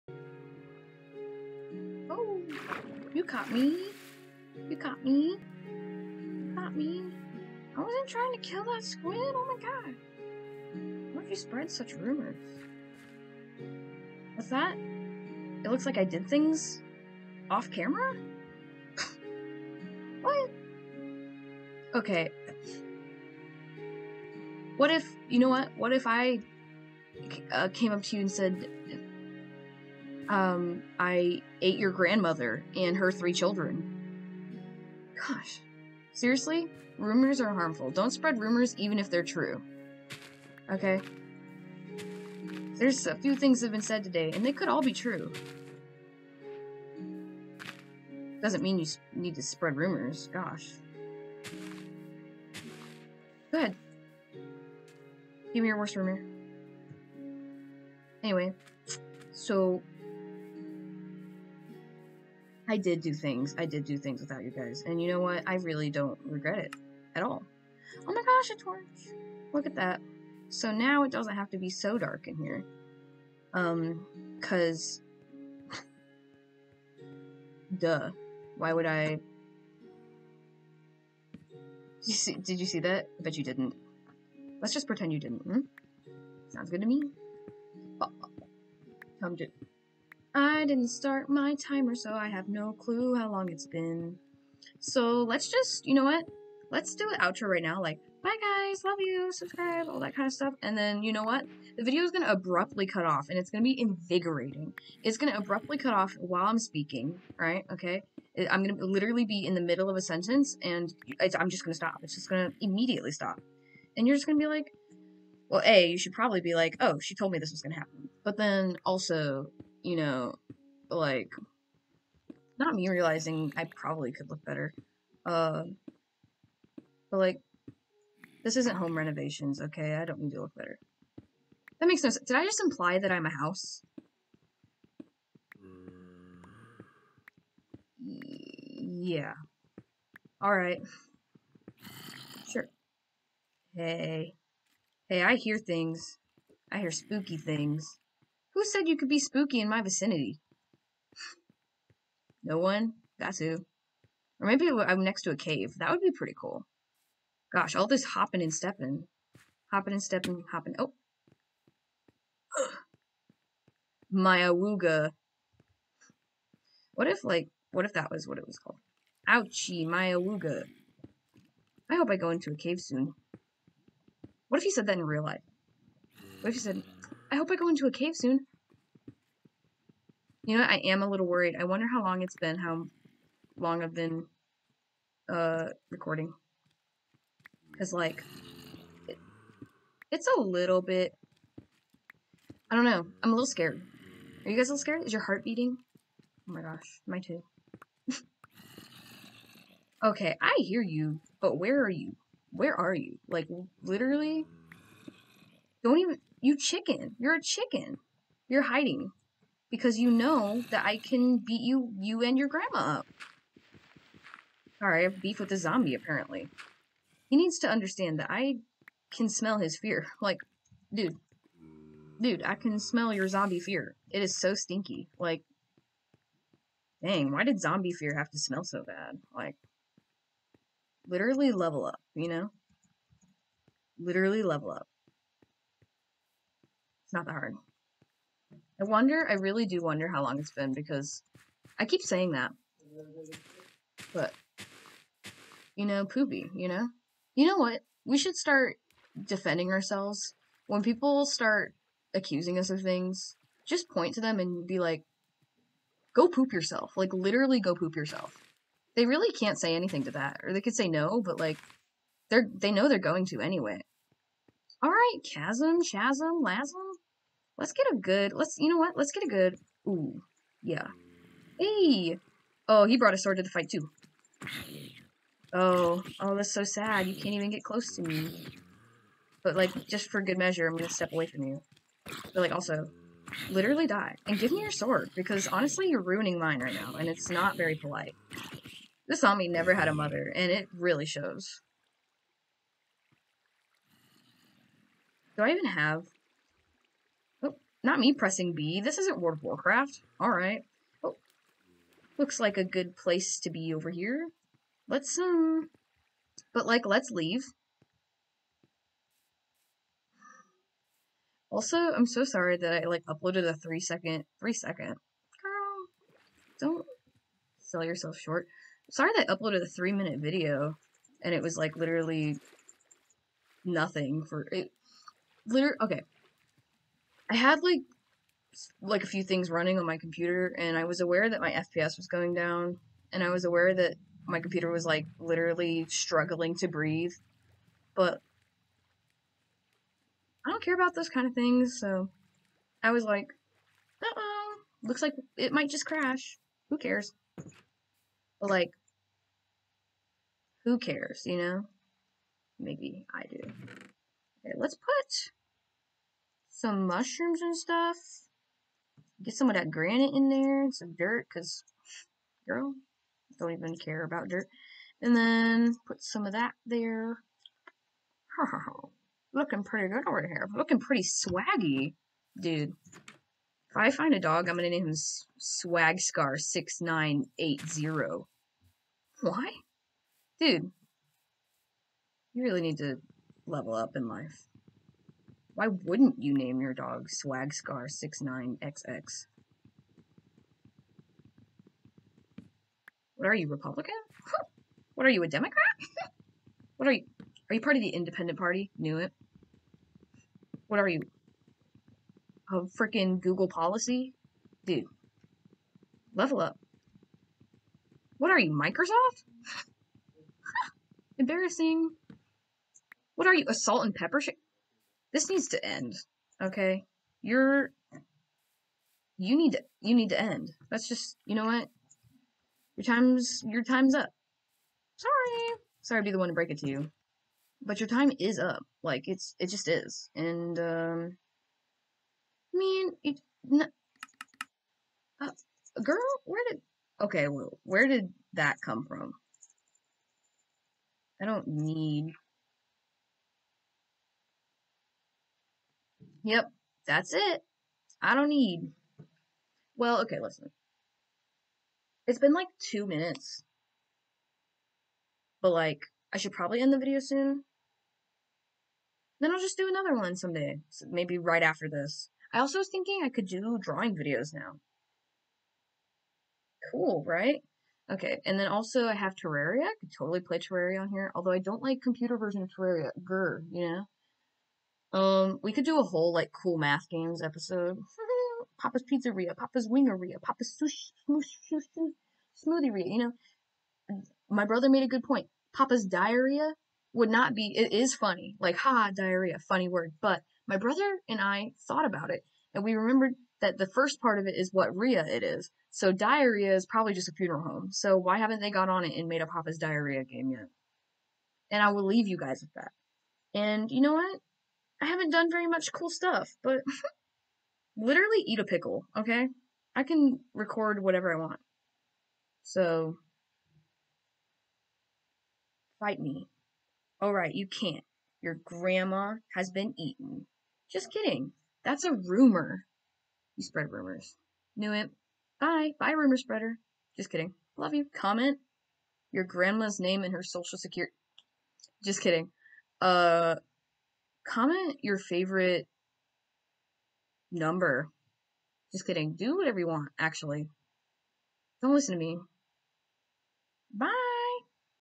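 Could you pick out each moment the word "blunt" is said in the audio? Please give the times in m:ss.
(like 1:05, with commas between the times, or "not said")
not said.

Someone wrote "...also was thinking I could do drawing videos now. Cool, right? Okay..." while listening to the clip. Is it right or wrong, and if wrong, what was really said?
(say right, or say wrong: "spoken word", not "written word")
right.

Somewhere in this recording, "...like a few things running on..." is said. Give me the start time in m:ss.
5:28.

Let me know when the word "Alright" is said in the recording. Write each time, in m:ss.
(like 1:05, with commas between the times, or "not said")
2:20, 4:24, 5:00, 8:37.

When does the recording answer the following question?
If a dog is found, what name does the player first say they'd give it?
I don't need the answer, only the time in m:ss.
6:15.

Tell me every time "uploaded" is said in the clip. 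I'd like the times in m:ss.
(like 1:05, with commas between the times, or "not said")
5:13, 5:19.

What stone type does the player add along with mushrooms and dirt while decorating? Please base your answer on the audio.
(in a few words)
Granite.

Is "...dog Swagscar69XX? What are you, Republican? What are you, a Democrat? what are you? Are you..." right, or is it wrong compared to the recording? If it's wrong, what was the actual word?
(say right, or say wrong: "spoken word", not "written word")
right.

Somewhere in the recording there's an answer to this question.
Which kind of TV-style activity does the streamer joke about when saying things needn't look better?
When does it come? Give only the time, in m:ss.
2:08.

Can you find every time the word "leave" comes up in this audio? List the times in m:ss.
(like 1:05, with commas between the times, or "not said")
5:07, 8:21.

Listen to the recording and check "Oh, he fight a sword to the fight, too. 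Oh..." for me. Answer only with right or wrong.
wrong.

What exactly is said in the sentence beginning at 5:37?
But I don't care about those kind of things, so I was like, uh-oh, looks like it might just crash.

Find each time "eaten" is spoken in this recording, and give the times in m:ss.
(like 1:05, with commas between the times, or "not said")
8:39.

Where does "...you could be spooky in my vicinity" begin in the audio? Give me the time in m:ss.
2:28.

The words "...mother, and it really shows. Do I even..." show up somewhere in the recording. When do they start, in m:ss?
4:49.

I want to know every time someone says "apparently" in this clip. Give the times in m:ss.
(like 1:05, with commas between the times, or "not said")
3:35.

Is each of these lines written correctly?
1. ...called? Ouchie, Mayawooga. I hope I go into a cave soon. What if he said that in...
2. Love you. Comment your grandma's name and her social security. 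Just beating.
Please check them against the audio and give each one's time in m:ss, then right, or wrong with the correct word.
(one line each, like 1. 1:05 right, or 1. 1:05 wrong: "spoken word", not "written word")
1. 2:48 right
2. 8:47 wrong: "kidding", not "beating".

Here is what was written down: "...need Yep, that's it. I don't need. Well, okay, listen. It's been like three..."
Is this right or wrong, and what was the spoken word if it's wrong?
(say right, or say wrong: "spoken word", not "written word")
wrong: "two", not "three".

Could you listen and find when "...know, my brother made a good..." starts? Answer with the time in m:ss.
8:02.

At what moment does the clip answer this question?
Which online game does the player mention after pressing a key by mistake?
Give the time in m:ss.
4:59.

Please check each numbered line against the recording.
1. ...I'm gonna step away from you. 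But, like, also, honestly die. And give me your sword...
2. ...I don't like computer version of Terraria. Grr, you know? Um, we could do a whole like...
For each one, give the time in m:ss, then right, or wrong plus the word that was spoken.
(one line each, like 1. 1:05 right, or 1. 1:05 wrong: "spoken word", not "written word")
1. 4:40 wrong: "literally", not "honestly"
2. 7:51 right.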